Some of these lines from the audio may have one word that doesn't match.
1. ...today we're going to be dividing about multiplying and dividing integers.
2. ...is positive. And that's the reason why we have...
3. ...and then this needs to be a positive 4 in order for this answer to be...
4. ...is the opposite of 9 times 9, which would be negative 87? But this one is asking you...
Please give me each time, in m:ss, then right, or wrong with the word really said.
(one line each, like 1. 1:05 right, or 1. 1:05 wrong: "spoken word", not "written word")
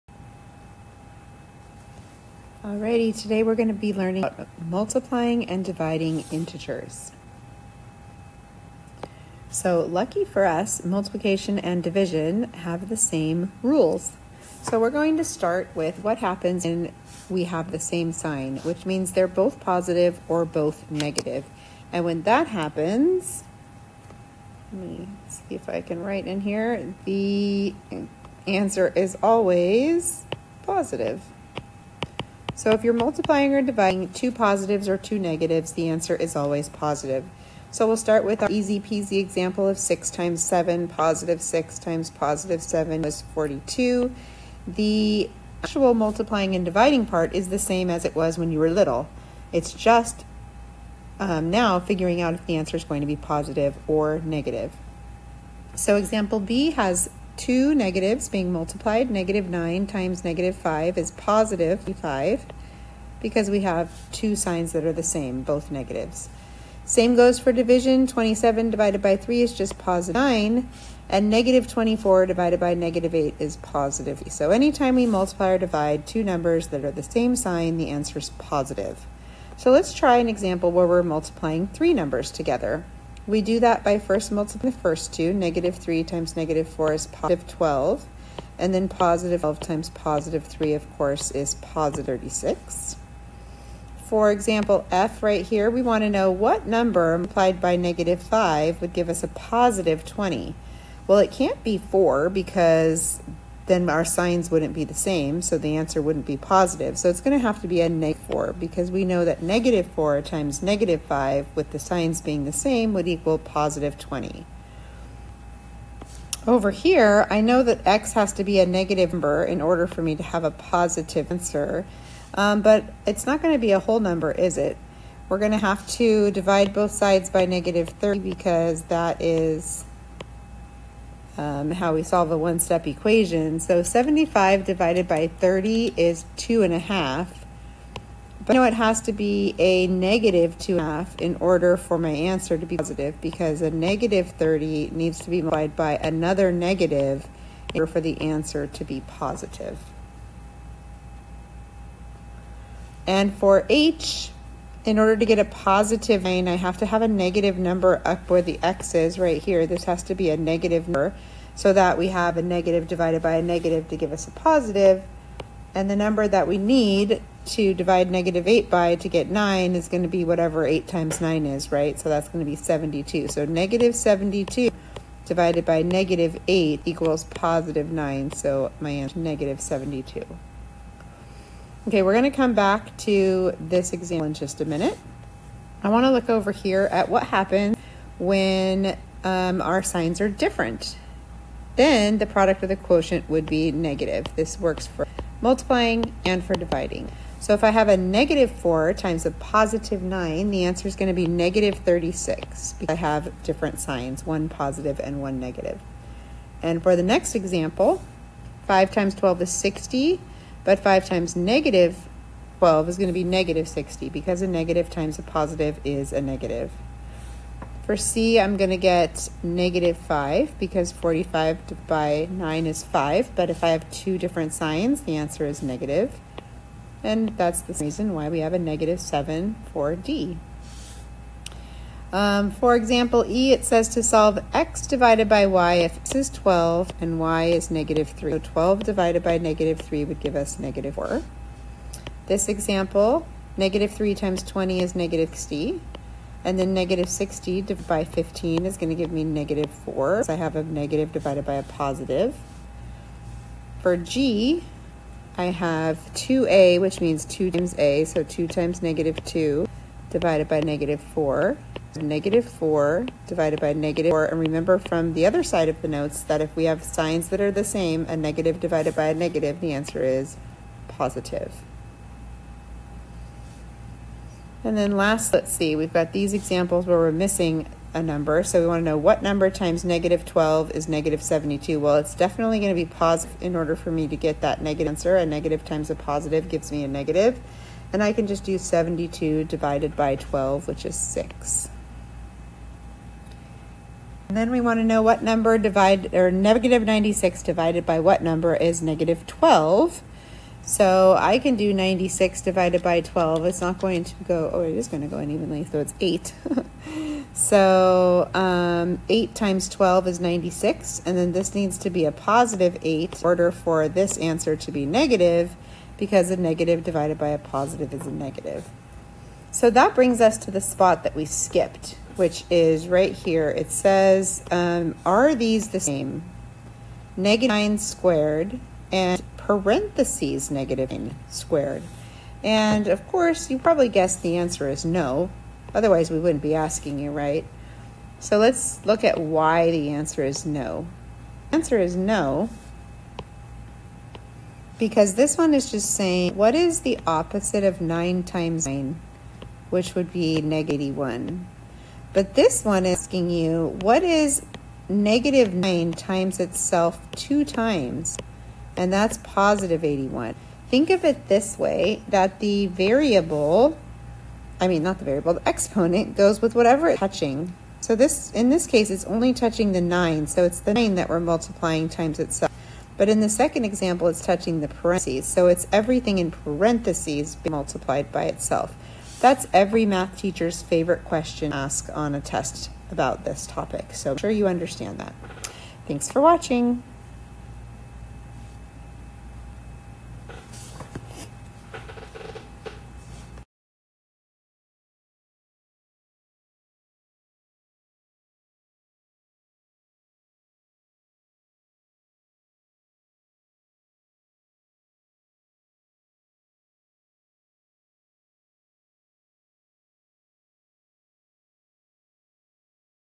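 1. 0:03 wrong: "learning", not "dividing"
2. 3:45 wrong: "negative", not "positive"
3. 5:11 wrong: "8", not "4"
4. 5:46 wrong: "81", not "87".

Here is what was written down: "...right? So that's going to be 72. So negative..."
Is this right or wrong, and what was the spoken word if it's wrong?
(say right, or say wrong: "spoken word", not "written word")
right.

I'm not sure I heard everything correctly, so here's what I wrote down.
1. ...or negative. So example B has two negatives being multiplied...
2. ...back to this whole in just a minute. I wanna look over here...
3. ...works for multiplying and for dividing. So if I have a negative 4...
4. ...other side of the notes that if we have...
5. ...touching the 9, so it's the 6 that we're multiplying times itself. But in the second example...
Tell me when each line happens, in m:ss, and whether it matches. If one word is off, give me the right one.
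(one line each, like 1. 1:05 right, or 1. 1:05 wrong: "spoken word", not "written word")
1. 0:53 right
2. 3:02 wrong: "example", not "whole"
3. 3:14 right
4. 4:25 right
5. 6:09 wrong: "9", not "6".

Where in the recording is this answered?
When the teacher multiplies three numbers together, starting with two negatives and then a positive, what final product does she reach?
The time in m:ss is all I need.
1:31.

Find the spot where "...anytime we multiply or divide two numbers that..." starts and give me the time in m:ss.
1:14.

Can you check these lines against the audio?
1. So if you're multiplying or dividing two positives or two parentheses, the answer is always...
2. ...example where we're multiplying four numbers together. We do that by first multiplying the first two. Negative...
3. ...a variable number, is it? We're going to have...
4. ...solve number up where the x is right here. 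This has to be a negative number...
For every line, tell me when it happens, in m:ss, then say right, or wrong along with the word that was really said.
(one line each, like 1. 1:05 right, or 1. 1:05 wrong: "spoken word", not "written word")
1. 0:32 wrong: "negatives", not "parentheses"
2. 1:20 wrong: "three", not "four"
3. 2:03 wrong: "whole", not "variable"
4. 2:37 wrong: "negative", not "solve".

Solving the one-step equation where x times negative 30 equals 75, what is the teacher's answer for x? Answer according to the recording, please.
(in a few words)
-2 1/2.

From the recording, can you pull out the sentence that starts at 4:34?
And then last, let's see, we've got these examples where we're missing a number.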